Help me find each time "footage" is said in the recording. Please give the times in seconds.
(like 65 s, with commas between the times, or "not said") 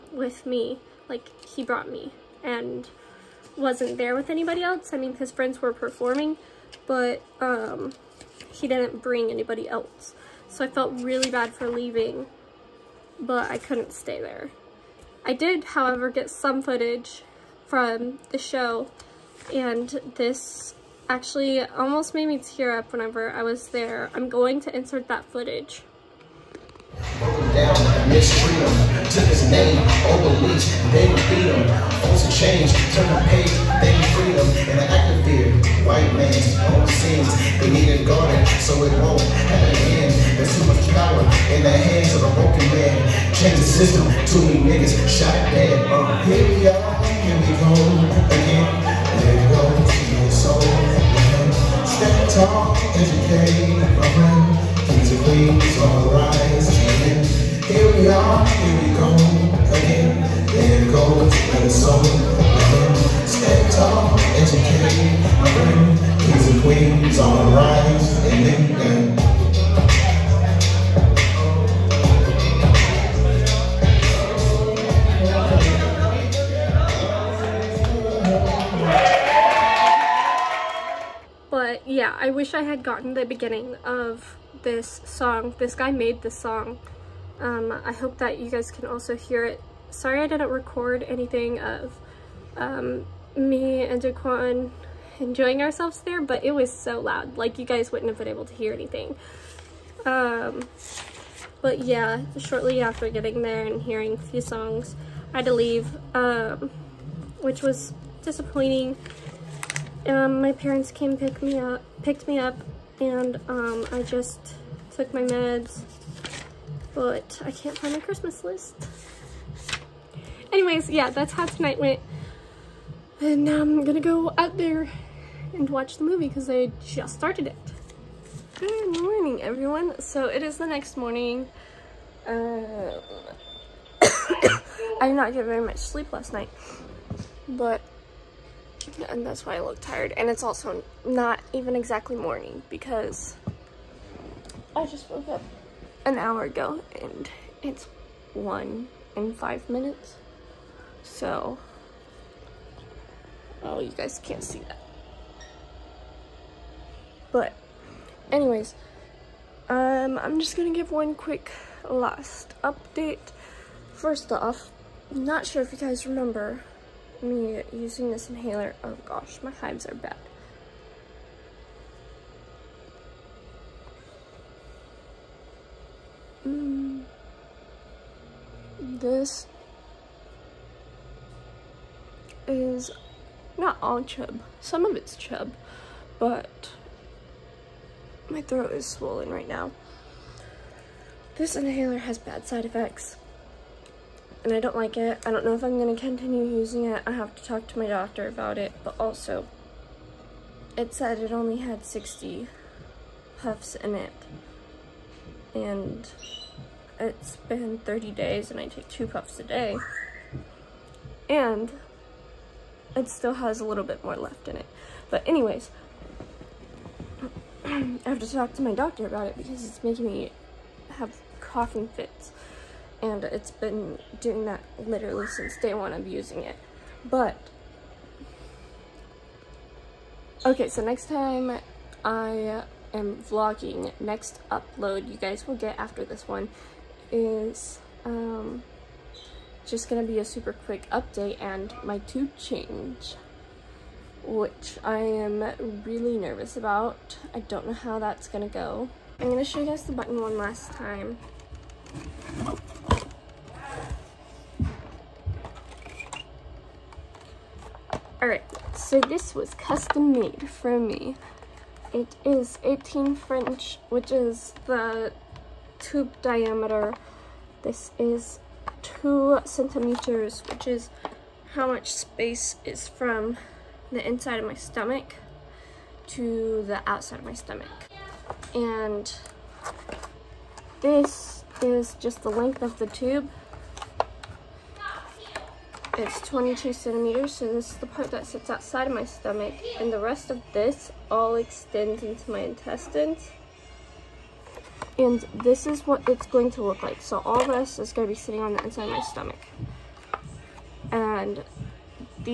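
16 s, 25 s.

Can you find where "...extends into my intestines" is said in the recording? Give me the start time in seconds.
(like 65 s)
291 s.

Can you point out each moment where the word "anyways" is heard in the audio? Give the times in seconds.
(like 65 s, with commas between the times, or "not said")
120 s, 158 s, 215 s.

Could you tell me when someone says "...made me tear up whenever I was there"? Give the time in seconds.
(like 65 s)
22 s.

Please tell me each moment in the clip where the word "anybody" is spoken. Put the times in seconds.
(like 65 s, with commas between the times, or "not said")
4 s, 9 s.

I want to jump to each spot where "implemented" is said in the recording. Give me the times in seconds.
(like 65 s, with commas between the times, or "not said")
not said.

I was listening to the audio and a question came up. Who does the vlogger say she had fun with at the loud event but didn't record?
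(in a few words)
Jaquan.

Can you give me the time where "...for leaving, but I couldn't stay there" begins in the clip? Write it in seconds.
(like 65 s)
11 s.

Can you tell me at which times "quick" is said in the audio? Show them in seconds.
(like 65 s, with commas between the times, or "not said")
161 s, 240 s.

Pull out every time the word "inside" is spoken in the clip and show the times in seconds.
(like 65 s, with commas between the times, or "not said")
274 s, 298 s.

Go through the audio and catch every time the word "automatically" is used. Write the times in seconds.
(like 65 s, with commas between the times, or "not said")
not said.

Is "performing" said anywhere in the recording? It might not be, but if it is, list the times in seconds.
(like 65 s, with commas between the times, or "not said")
5 s.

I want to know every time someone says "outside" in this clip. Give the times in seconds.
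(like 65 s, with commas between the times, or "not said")
276 s, 288 s.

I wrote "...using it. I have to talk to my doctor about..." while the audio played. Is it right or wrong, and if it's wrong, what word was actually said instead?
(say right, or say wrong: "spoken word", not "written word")
right.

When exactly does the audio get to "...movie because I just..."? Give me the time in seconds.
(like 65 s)
126 s.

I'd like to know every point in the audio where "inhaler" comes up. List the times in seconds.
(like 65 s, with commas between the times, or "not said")
168 s, 191 s.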